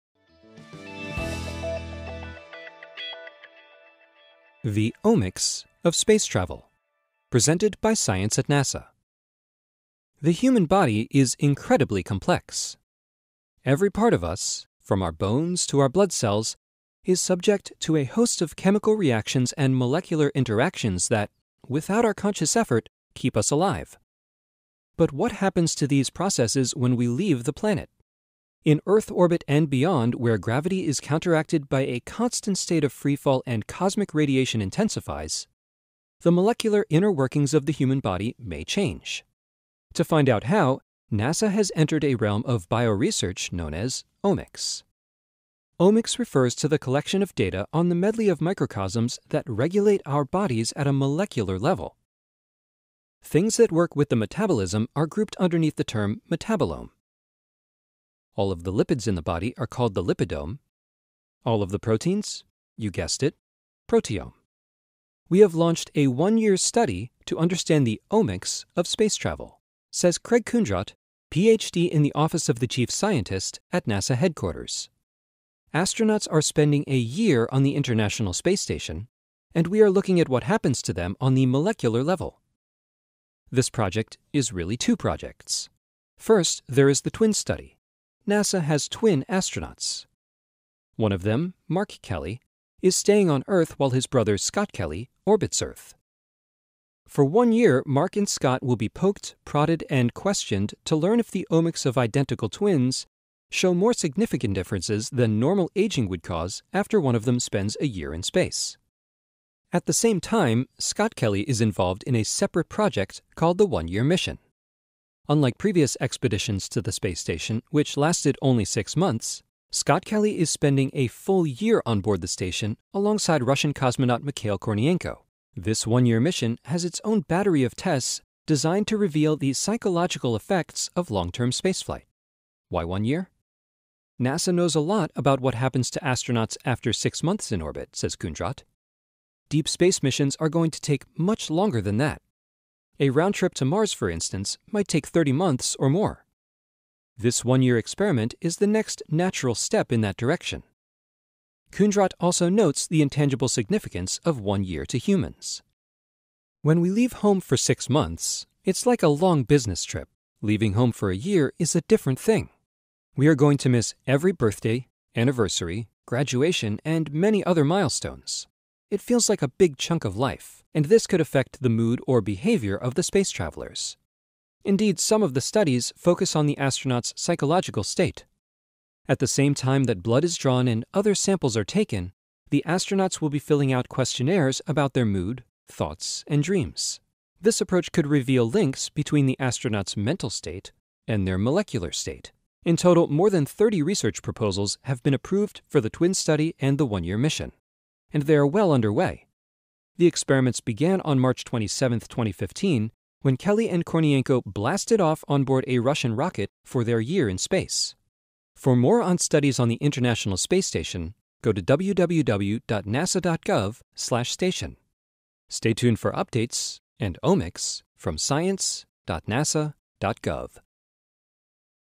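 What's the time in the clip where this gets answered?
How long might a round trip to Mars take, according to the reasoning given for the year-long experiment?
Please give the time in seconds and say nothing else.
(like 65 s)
145 s.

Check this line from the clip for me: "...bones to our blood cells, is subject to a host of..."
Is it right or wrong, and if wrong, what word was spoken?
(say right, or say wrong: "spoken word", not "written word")
right.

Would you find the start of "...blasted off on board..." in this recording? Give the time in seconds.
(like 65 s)
204 s.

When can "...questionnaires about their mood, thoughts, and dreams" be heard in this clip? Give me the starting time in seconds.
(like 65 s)
183 s.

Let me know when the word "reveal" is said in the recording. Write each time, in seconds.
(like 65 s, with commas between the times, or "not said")
128 s, 188 s.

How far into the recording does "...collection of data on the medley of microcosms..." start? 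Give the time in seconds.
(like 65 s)
46 s.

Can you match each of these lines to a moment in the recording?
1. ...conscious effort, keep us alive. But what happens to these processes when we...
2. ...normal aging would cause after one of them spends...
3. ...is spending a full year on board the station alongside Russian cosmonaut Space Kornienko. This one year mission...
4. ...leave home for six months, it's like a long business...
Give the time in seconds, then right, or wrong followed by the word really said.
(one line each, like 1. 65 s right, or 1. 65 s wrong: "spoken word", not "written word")
1. 22 s right
2. 105 s right
3. 120 s wrong: "Mikhail", not "Space"
4. 156 s right.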